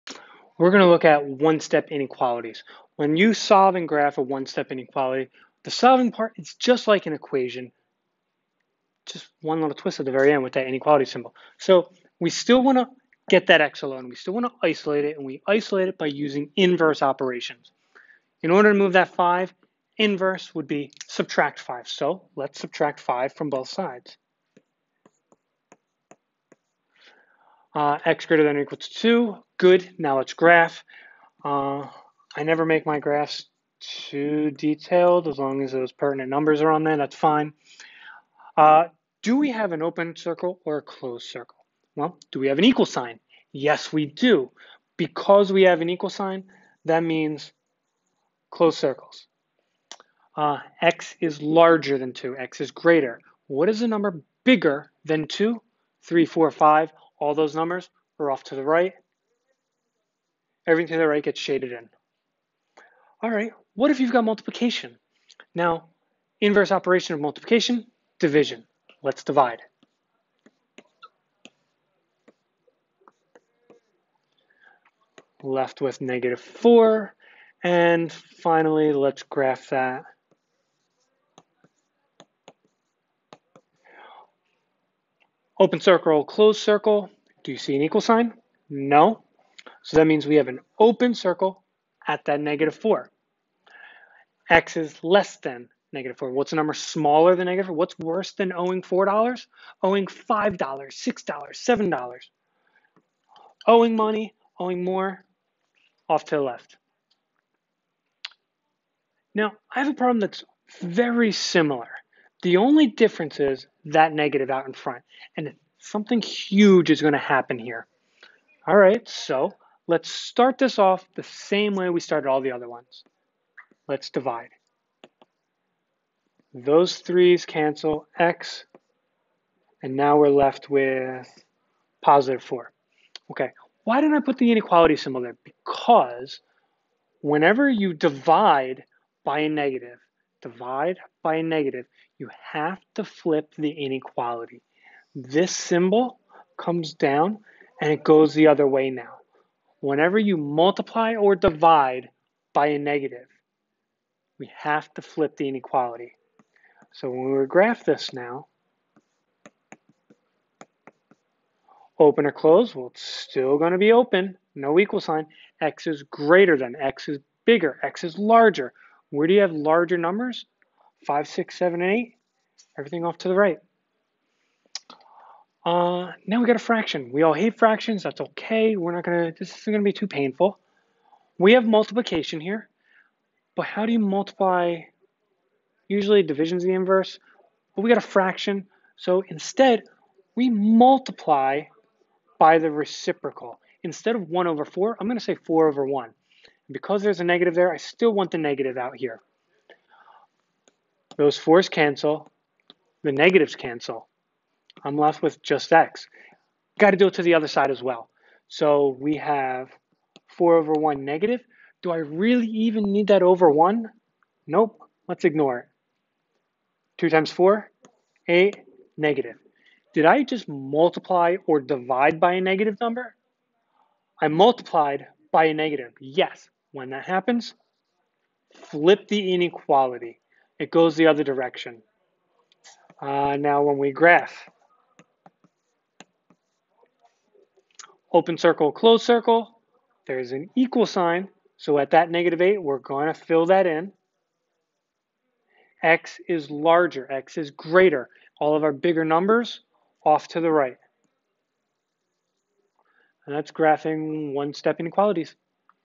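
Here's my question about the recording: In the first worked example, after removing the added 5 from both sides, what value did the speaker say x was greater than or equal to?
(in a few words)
2.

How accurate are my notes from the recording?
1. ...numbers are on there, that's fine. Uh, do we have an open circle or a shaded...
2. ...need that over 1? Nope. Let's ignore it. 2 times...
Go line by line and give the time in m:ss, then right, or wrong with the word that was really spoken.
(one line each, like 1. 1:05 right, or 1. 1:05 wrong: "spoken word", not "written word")
1. 0:36 wrong: "closed", not "shaded"
2. 3:32 right.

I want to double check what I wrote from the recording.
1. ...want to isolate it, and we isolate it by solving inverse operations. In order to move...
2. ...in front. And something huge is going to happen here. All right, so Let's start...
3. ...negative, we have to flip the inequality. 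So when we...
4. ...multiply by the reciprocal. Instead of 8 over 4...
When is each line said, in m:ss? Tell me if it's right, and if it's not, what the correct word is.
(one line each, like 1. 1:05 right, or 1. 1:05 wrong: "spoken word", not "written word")
1. 0:14 wrong: "using", not "solving"
2. 1:54 right
3. 2:32 right
4. 3:10 wrong: "1", not "8".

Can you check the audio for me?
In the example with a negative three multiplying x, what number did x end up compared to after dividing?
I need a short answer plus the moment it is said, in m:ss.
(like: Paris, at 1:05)
positive 4, at 2:12.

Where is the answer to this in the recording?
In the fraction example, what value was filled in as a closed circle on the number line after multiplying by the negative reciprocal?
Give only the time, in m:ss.
4:02.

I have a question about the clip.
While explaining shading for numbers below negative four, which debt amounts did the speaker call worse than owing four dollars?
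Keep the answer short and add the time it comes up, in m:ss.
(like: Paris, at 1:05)
$5, $6, $7, at 1:39.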